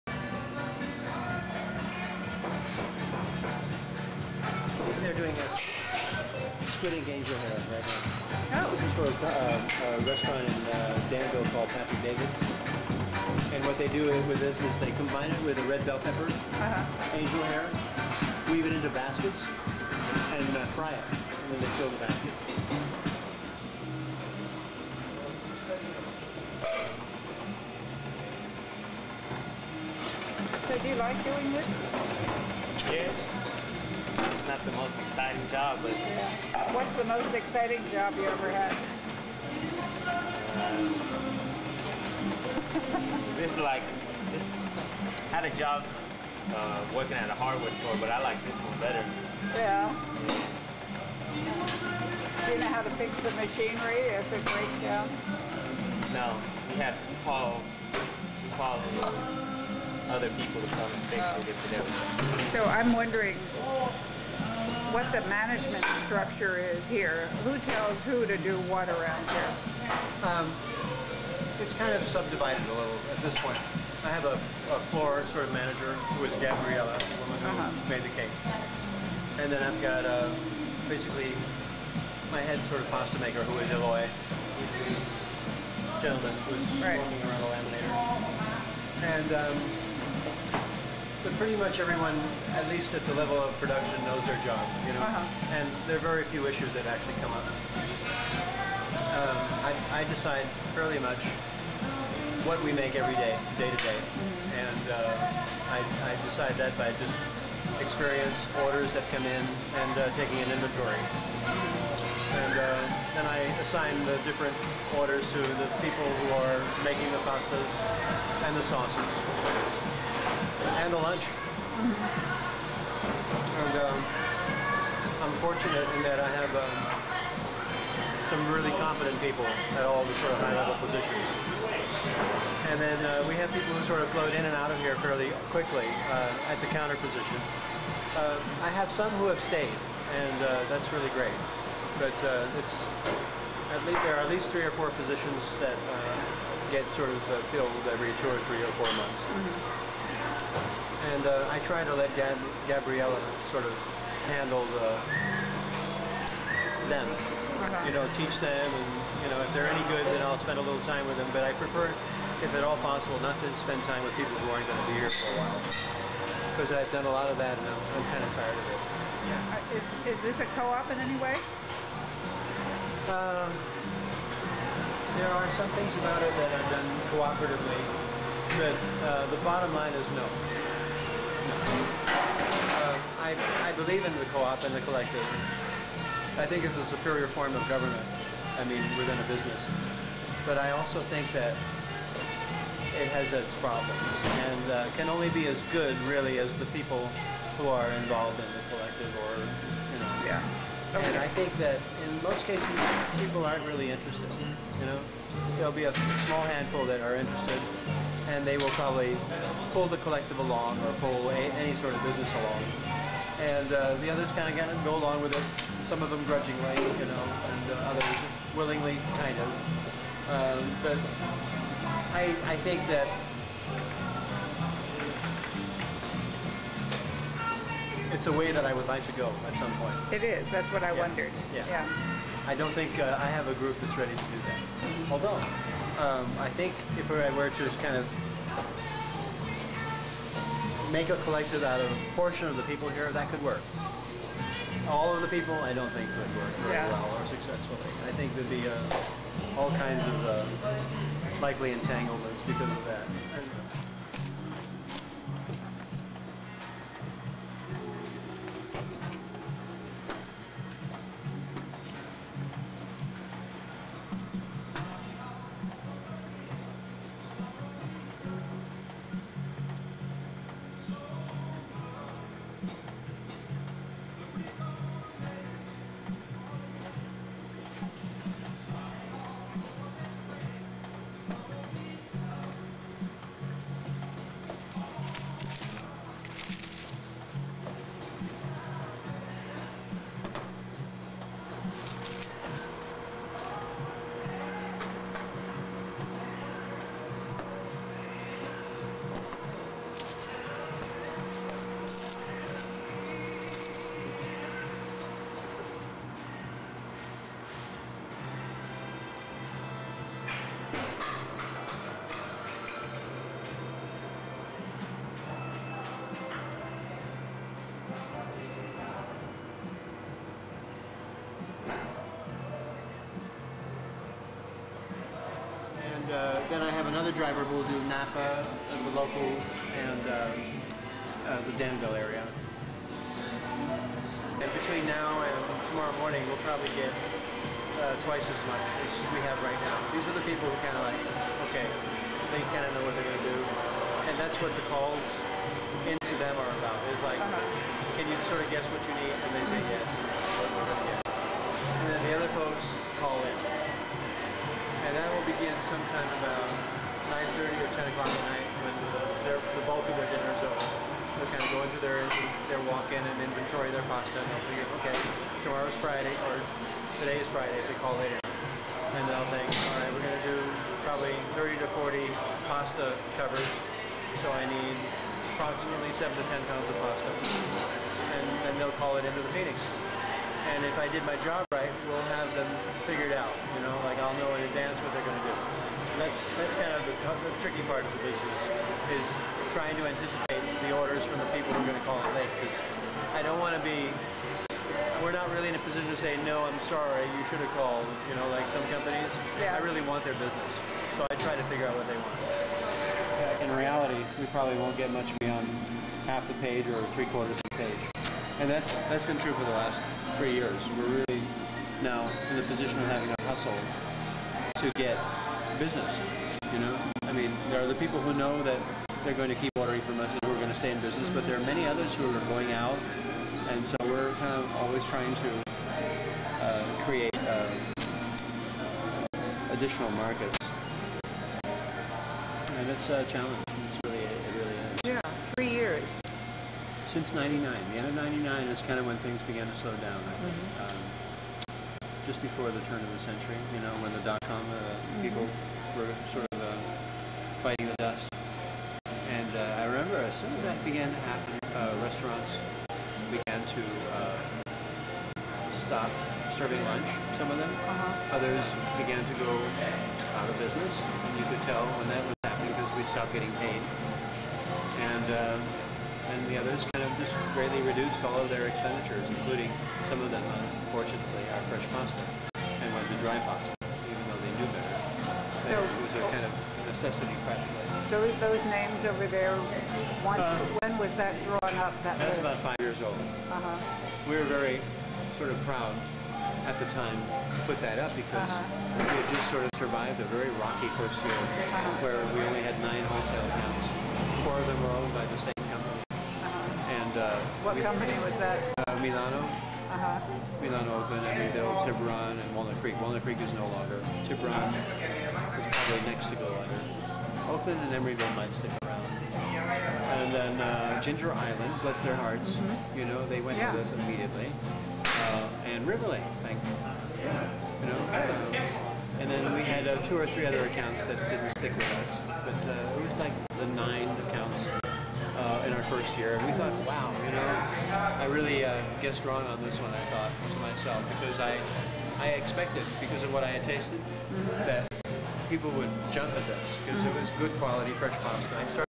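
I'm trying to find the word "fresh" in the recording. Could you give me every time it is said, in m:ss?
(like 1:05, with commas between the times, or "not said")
7:51, 8:57.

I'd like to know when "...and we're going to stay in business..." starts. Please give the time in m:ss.
7:00.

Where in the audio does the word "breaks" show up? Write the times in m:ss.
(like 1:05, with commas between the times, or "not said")
0:54.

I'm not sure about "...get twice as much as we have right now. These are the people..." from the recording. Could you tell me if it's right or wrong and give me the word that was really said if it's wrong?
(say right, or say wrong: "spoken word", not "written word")
right.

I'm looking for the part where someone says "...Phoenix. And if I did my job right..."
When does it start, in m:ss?
6:19.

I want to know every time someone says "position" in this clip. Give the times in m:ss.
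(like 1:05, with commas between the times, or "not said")
2:10, 2:16, 2:24, 6:35, 6:52.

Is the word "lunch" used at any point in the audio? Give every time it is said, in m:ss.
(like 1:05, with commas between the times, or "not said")
2:00, 7:36.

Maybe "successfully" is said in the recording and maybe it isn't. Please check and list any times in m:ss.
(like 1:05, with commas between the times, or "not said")
4:07.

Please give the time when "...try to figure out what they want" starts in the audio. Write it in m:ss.
6:41.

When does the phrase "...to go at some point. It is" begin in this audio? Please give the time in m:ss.
3:49.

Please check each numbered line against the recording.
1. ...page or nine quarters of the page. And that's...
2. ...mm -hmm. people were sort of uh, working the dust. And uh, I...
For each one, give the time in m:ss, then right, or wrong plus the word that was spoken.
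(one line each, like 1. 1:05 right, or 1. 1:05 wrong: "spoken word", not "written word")
1. 6:46 wrong: "three", not "nine"
2. 7:24 wrong: "biting", not "working".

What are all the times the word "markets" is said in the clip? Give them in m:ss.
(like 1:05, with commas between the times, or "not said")
7:09.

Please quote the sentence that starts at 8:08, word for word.
we had just sort of survived a very rocky first year uh-huh.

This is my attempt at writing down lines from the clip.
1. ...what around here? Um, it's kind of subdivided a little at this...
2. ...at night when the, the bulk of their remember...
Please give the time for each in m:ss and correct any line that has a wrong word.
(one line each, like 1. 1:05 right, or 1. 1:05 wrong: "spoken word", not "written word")
1. 1:08 right
2. 5:58 wrong: "dinner", not "remember".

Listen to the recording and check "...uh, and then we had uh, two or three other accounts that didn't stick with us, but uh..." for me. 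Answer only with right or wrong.
right.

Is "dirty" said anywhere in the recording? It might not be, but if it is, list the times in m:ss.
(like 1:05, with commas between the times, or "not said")
not said.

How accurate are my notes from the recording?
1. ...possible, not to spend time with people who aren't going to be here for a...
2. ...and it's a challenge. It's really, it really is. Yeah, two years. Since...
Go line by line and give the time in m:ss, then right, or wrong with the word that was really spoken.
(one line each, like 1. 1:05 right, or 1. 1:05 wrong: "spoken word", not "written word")
1. 2:42 right
2. 7:11 wrong: "three", not "two".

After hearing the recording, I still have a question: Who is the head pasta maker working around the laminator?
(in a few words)
Eloy.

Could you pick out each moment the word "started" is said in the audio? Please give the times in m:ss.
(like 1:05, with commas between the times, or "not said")
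8:58.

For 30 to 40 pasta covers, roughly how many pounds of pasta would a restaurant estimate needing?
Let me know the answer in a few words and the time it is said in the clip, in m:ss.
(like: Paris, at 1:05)
7 to 10 pounds, at 6:15.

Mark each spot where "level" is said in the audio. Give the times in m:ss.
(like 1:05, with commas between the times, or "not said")
1:33, 2:10.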